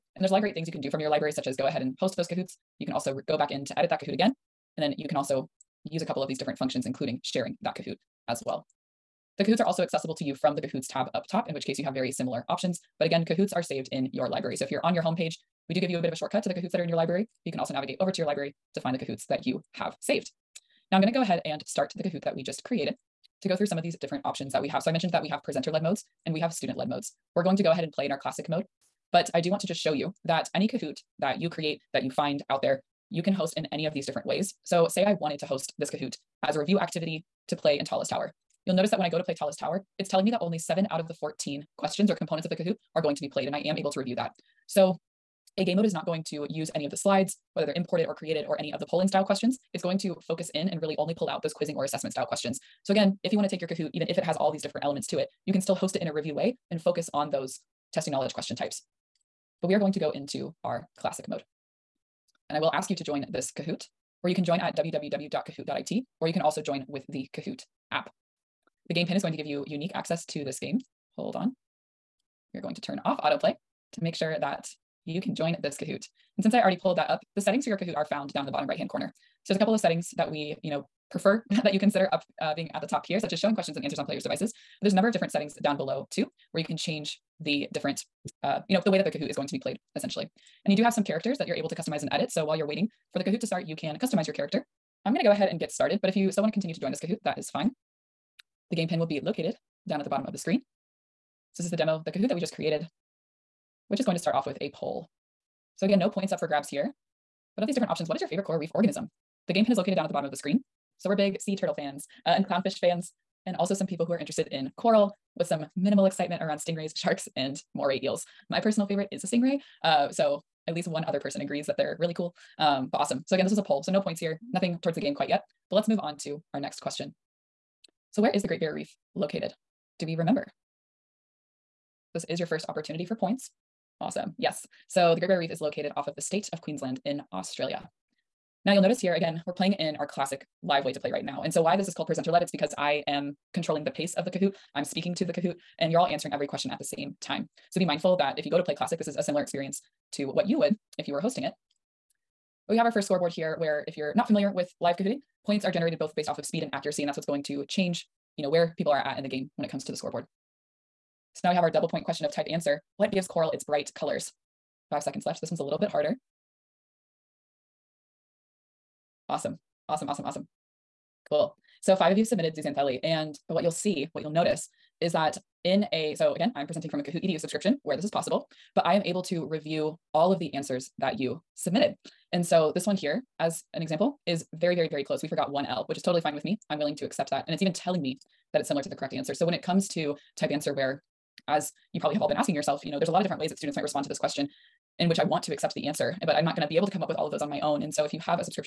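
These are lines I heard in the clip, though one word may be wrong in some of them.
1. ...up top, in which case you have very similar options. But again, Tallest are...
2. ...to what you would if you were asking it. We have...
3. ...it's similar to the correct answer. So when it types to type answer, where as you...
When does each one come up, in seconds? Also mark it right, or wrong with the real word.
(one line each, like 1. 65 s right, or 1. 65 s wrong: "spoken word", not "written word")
1. 11 s wrong: "Kahoots", not "Tallest"
2. 150 s wrong: "hosting", not "asking"
3. 188 s wrong: "comes", not "types".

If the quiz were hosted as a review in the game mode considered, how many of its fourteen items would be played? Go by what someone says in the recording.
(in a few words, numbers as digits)
7.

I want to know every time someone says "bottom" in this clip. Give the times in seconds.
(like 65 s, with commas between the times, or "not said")
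78 s, 100 s, 110 s.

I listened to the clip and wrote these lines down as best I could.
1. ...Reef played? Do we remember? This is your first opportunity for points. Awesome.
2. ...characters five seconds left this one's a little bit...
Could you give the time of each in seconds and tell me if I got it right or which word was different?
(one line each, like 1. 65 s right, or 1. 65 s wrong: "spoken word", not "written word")
1. 128 s wrong: "located", not "played"
2. 163 s wrong: "colors", not "characters".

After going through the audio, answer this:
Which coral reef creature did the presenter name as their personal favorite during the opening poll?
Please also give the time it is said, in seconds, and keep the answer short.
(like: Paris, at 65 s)
Stingray, at 119 s.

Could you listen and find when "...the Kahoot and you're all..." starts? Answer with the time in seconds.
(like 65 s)
145 s.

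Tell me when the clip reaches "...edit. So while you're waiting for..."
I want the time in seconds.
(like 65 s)
92 s.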